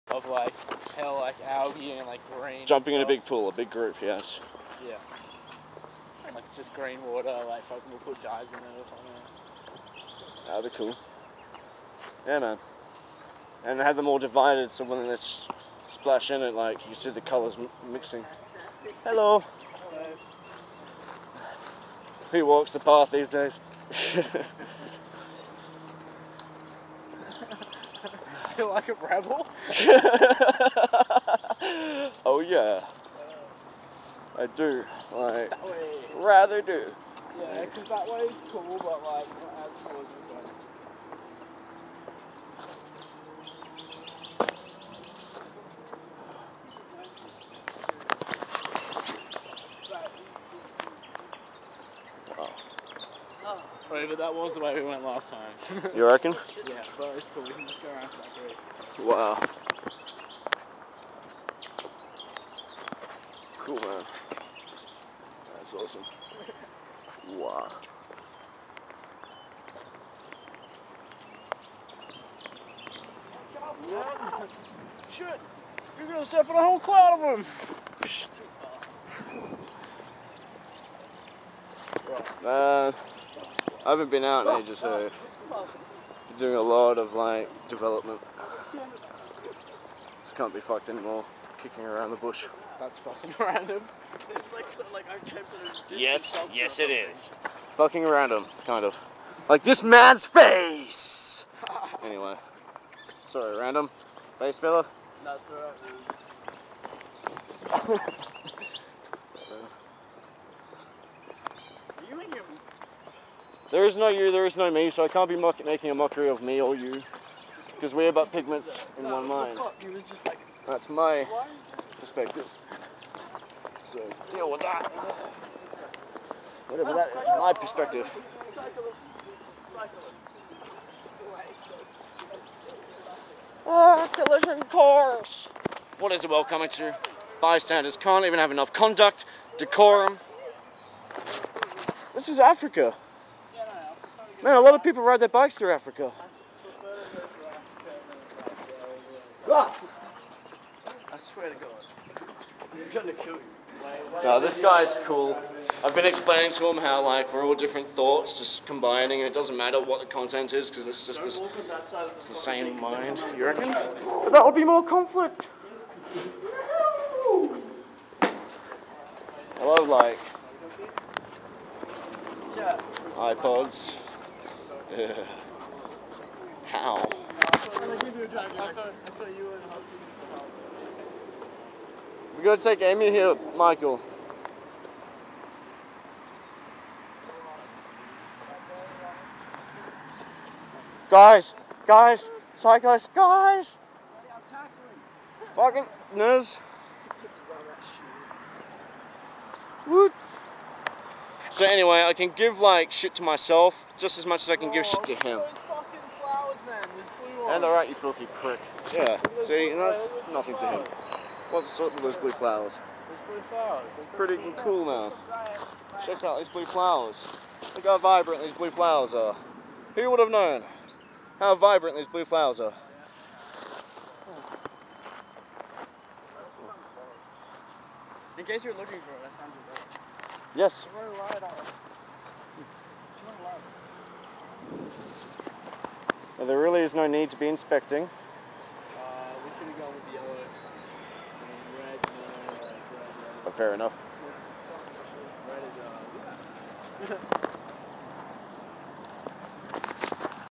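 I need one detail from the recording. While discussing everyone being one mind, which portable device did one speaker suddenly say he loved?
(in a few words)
iPods.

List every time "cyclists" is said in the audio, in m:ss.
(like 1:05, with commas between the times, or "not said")
3:12.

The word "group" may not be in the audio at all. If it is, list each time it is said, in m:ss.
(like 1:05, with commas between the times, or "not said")
0:03, 0:58.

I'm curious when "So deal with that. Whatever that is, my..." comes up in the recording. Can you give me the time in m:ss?
2:03.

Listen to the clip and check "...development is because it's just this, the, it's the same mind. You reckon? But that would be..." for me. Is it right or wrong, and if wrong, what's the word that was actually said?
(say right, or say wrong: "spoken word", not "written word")
wrong: "content", not "development".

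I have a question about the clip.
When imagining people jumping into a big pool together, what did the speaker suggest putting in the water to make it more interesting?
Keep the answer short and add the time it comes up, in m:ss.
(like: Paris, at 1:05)
dyes, at 0:08.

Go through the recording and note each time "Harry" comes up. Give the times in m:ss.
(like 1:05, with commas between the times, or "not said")
not said.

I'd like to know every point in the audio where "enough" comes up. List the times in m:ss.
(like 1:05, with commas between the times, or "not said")
2:18, 4:03.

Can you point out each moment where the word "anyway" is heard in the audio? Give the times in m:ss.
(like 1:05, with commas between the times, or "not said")
1:42, 3:21.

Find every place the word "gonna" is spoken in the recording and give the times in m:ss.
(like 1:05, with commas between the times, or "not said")
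1:16, 2:32, 3:02.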